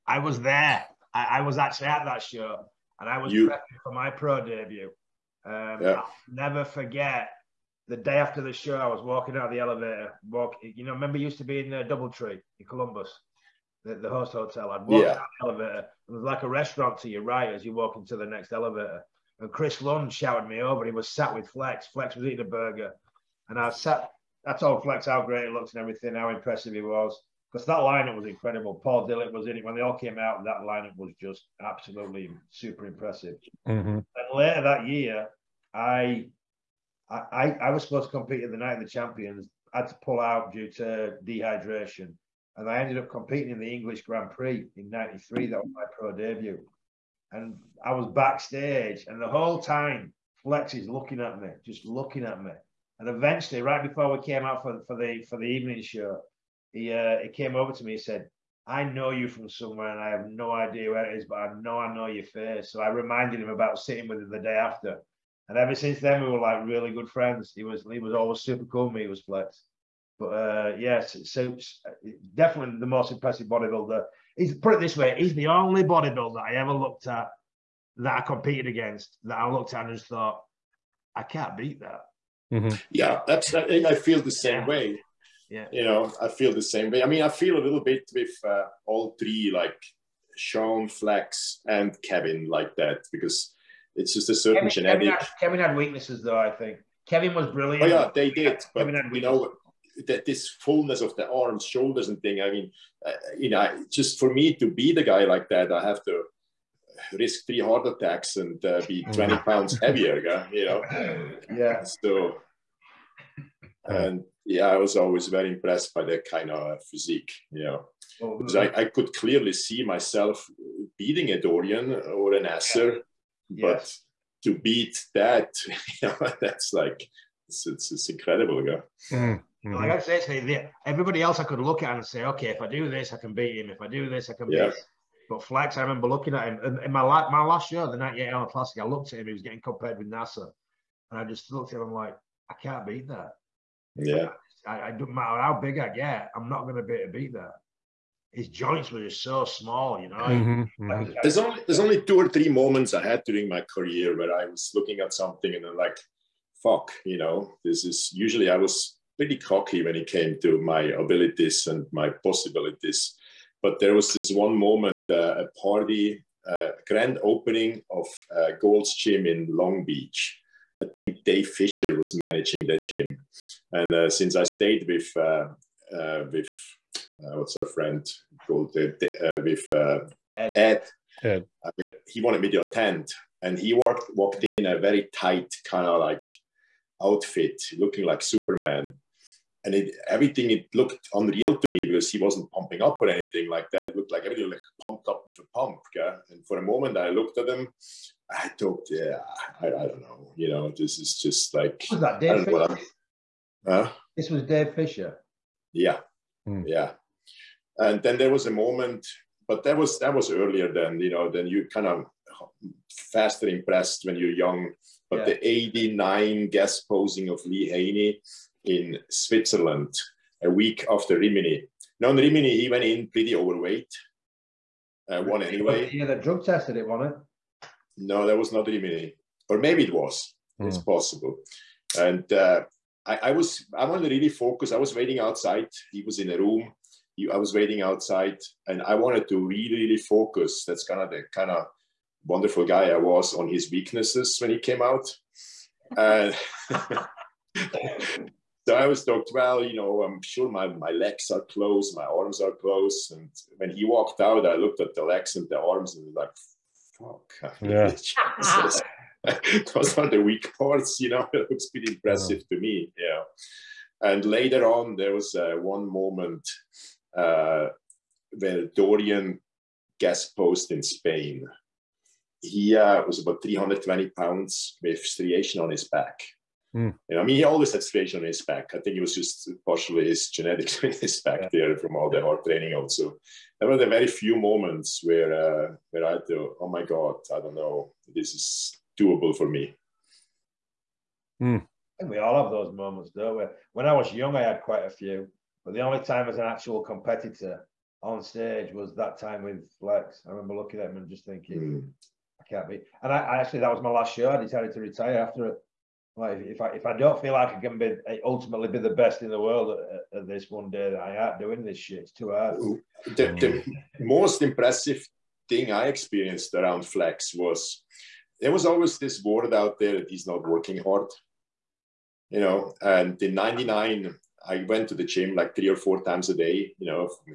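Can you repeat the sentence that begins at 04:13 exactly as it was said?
And when he walked out, I looked at the legs and the arms and was like, fuck.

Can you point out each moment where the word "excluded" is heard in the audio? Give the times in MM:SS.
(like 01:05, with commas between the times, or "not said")
not said.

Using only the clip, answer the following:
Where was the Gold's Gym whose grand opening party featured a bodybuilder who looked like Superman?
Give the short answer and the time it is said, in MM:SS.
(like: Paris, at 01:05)
Long Beach, at 02:49.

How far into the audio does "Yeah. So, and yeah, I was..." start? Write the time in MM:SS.
01:51.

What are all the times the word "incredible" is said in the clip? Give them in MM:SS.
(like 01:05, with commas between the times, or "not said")
00:28, 02:08.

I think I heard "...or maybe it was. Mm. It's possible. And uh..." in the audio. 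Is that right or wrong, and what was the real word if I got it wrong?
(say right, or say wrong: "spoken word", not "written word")
right.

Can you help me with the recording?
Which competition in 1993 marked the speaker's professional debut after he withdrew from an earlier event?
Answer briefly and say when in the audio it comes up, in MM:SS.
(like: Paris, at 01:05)
English Grand Prix, at 00:43.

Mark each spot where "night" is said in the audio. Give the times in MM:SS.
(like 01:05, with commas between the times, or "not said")
00:38.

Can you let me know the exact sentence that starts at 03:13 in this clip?
It looked like everything like pumped up with a pump.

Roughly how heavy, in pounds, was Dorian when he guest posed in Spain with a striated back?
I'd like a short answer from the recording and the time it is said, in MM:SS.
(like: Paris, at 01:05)
320, at 04:33.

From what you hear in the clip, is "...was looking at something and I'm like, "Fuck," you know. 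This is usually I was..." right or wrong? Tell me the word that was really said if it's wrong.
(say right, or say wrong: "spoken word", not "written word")
right.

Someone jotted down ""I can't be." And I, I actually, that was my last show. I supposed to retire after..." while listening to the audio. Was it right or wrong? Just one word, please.
wrong.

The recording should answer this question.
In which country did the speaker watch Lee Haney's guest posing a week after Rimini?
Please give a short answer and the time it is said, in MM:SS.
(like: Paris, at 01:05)
Switzerland, at 03:39.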